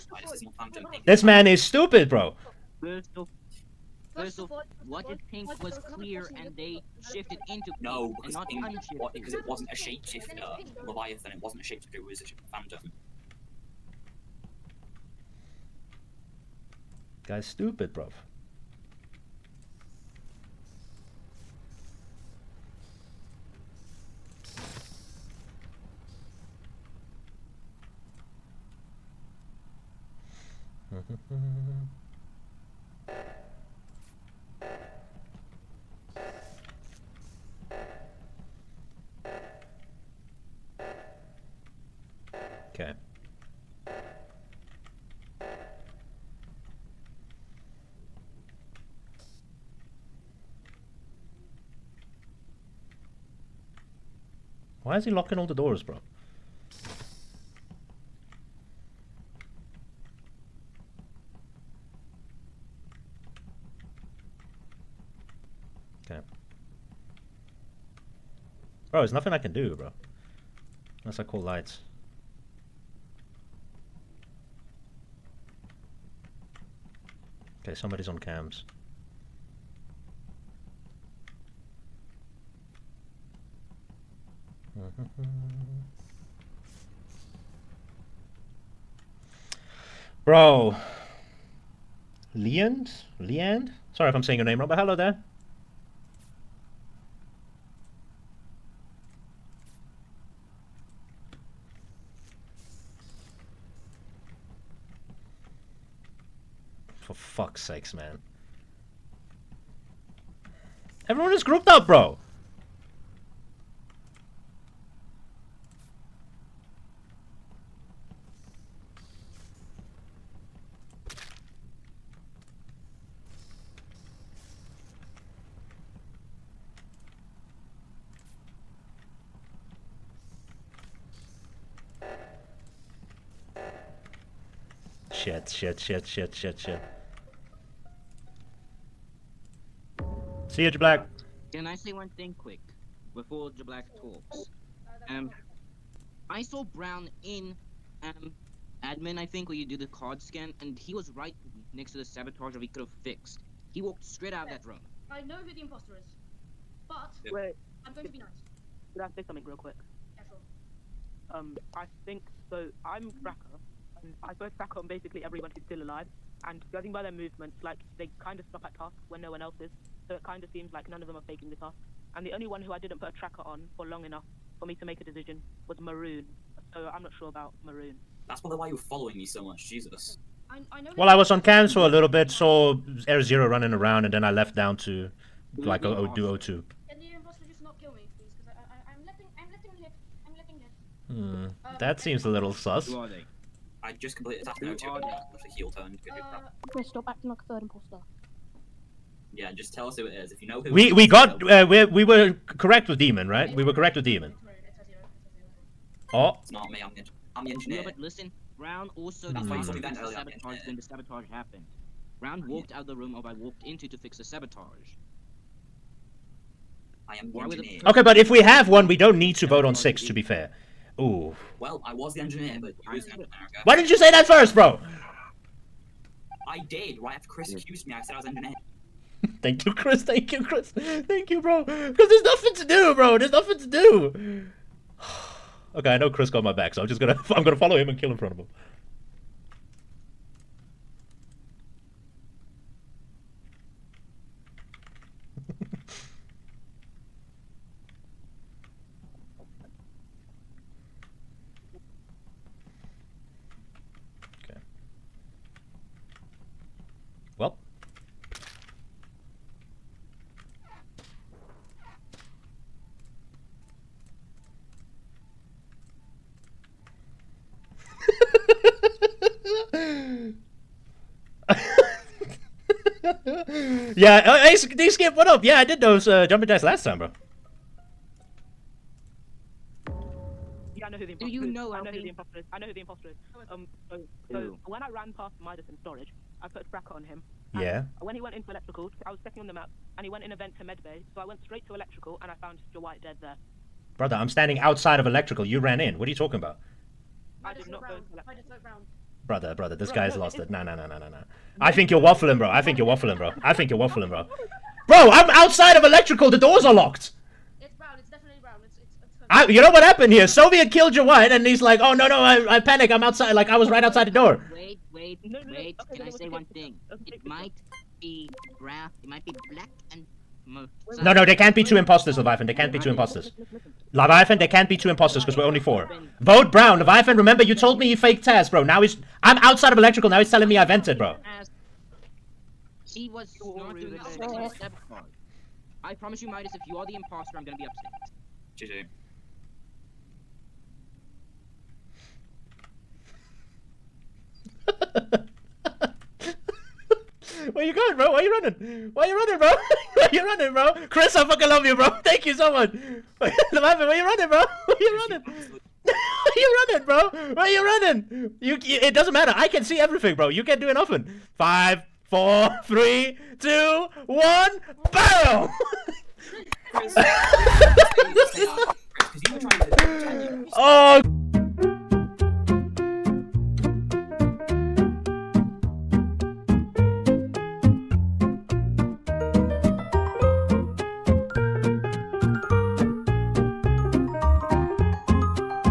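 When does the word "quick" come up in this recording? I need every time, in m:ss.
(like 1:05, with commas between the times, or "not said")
2:22, 2:39.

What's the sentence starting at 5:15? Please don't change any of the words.
Okay, Can I say one thing?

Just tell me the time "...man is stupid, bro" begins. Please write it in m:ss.
0:01.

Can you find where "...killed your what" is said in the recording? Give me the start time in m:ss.
5:10.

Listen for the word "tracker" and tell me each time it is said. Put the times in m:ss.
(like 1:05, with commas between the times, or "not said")
2:43, 2:53.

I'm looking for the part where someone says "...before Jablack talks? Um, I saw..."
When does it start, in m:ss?
2:23.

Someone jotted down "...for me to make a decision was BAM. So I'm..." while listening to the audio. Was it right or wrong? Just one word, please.
wrong.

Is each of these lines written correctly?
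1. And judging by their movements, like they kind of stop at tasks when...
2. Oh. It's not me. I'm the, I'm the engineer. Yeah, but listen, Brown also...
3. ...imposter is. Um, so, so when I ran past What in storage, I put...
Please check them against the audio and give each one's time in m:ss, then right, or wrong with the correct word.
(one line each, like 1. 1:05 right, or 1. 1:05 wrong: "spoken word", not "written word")
1. 2:46 right
2. 3:26 right
3. 4:42 wrong: "Midus", not "What".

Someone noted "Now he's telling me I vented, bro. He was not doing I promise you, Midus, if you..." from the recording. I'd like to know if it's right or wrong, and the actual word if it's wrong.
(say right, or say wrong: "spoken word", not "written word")
right.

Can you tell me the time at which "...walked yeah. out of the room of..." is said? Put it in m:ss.
3:32.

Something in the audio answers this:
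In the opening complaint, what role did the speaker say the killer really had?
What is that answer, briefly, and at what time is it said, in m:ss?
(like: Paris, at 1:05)
Phantom, at 0:11.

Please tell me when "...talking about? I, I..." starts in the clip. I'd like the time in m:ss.
4:56.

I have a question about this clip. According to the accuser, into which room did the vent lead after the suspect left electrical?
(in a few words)
Medbay.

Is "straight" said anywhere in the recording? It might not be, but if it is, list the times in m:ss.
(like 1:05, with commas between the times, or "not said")
2:34, 4:51.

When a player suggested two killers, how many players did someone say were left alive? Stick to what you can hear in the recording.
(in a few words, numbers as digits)
4.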